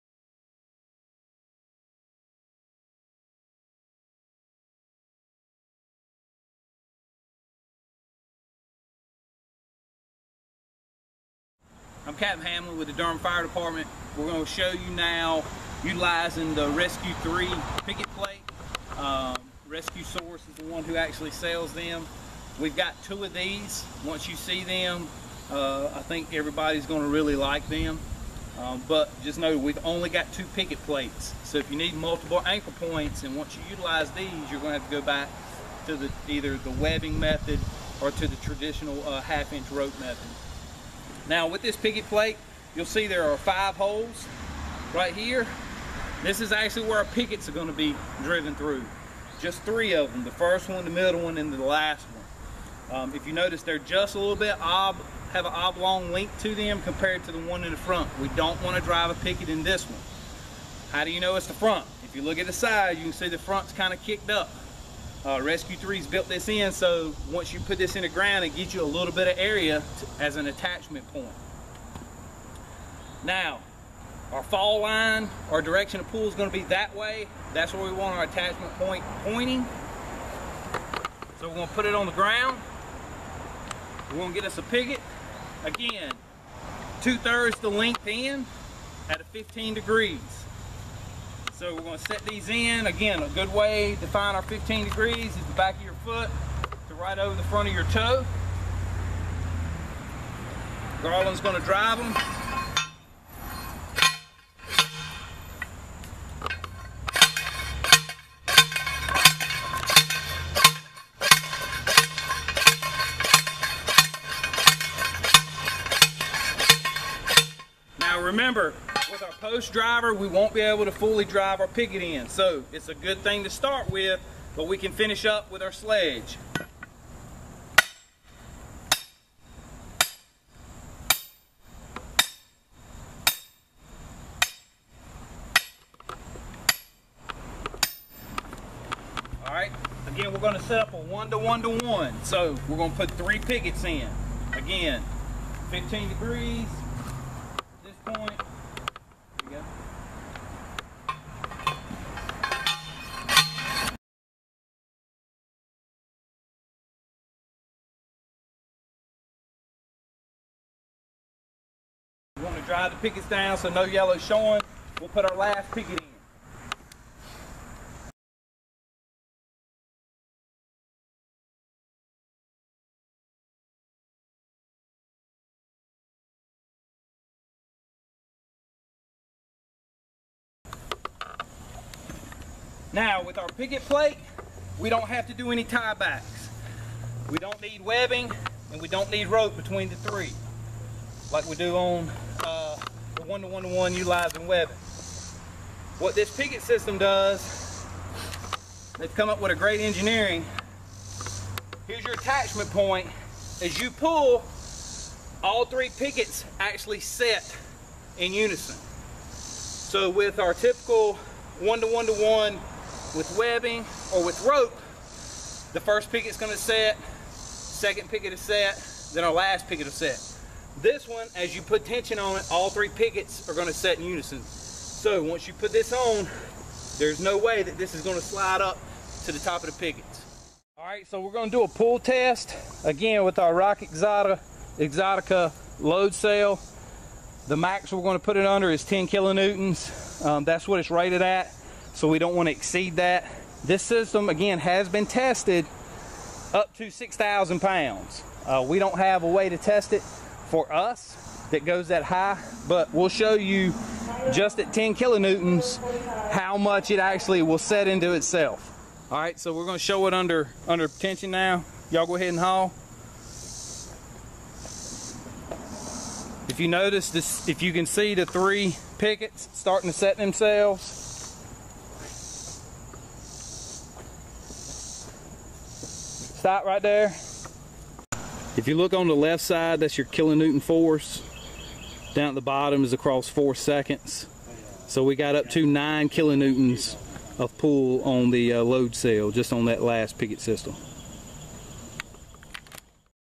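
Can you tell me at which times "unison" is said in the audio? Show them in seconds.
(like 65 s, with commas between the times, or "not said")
208 s, 224 s.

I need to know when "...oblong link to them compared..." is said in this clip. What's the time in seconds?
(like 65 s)
55 s.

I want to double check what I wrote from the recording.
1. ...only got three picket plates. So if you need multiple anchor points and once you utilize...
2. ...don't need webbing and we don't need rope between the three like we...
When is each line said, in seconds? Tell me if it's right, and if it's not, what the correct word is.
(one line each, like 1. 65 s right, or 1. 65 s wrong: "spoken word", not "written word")
1. 29 s wrong: "two", not "three"
2. 187 s right.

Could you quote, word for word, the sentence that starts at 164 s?
We'll put our last picket in.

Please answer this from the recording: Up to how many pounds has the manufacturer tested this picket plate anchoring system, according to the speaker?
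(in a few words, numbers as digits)
6,000 pounds.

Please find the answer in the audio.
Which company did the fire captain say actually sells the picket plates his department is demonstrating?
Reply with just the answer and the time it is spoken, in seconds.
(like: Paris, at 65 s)
Rescue Source, at 19 s.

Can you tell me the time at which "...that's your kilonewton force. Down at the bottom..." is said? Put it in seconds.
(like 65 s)
279 s.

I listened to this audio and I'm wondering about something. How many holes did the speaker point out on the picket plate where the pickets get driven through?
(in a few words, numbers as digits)
5.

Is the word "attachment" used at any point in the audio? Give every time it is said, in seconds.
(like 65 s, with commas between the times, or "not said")
70 s, 78 s, 202 s.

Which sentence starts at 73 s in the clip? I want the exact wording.
Now our fall line, our direction of pull is going to be that way.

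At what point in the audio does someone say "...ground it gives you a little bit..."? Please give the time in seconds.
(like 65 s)
68 s.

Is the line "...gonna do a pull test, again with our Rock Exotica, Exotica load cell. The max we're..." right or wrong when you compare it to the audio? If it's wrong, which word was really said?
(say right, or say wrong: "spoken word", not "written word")
right.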